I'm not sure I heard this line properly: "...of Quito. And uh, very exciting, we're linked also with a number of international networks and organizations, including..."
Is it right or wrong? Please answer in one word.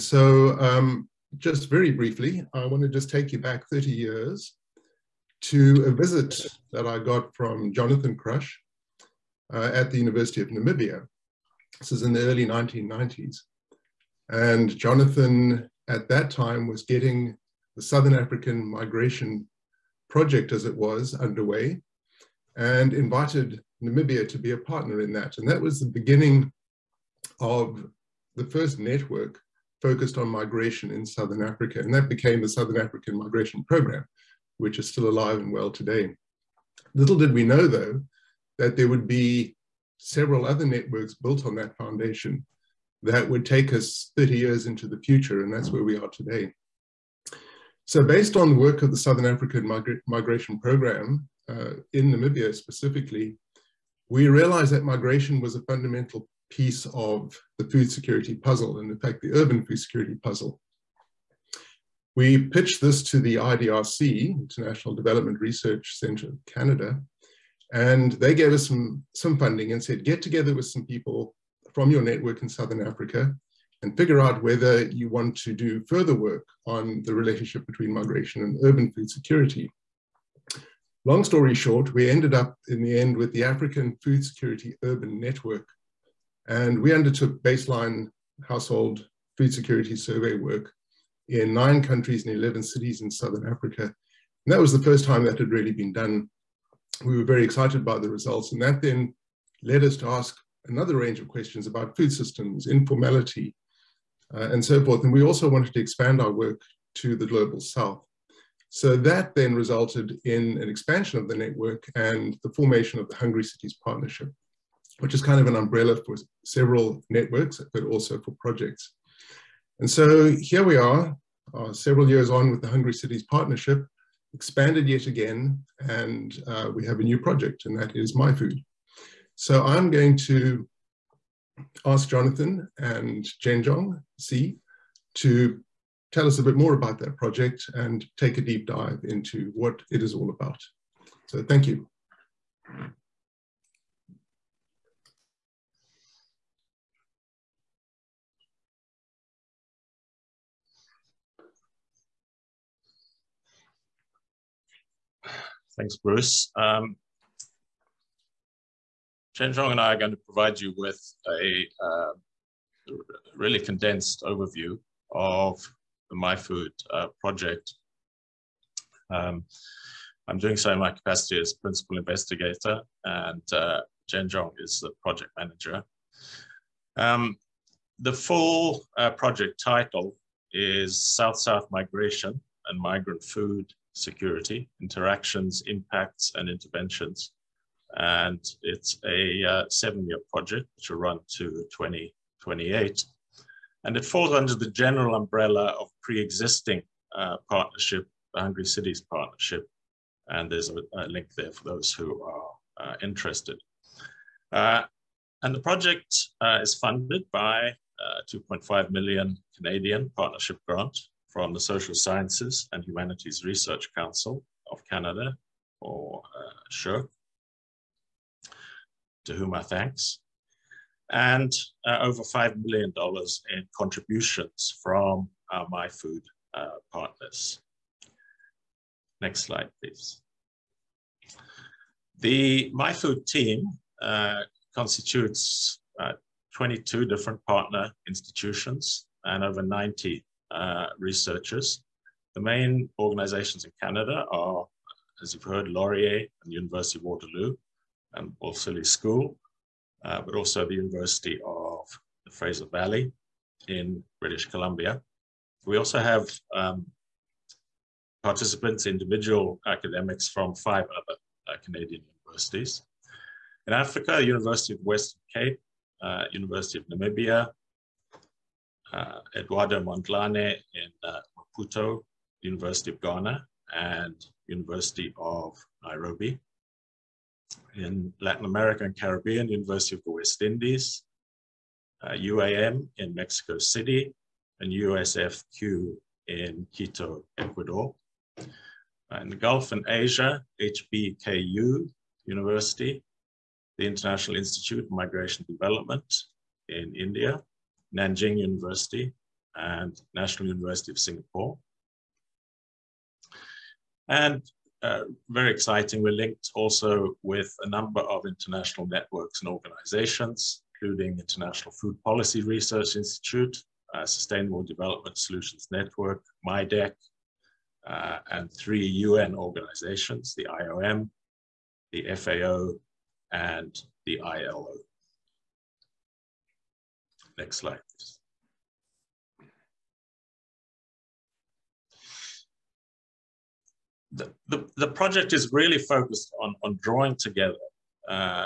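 wrong.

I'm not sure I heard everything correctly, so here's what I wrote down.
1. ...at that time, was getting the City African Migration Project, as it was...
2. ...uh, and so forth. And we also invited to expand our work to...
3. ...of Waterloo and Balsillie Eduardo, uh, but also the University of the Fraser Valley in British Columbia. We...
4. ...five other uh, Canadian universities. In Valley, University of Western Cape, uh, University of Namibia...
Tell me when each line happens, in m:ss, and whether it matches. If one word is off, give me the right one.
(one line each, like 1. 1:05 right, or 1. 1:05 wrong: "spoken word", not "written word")
1. 0:15 wrong: "Southern", not "City"
2. 1:44 wrong: "wanted", not "invited"
3. 4:06 wrong: "School", not "Eduardo"
4. 4:20 wrong: "Africa", not "Valley".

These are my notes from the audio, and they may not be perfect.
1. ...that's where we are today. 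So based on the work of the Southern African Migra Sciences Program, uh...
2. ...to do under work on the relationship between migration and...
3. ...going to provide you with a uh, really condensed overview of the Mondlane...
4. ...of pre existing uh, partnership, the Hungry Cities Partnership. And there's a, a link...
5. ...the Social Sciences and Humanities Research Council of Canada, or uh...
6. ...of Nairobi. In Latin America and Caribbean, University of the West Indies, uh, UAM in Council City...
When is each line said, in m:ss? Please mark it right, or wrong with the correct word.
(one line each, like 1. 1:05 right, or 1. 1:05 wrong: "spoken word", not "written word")
1. 0:45 wrong: "Migration", not "Sciences"
2. 1:15 wrong: "further", not "under"
3. 2:39 wrong: "MiFOOD", not "Mondlane"
4. 3:15 right
5. 3:31 right
6. 4:35 wrong: "Mexico", not "Council".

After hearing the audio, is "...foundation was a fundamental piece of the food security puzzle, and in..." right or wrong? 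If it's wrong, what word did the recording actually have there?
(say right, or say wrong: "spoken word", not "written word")
wrong: "migration", not "foundation".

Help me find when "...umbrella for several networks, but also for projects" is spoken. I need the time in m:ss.
1:55.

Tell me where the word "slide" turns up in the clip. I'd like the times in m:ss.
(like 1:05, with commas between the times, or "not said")
3:49, 5:27.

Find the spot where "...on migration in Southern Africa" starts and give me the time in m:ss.
0:30.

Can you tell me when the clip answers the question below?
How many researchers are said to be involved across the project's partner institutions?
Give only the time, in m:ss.
3:59.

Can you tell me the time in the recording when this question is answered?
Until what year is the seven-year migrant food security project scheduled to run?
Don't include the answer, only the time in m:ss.
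3:11.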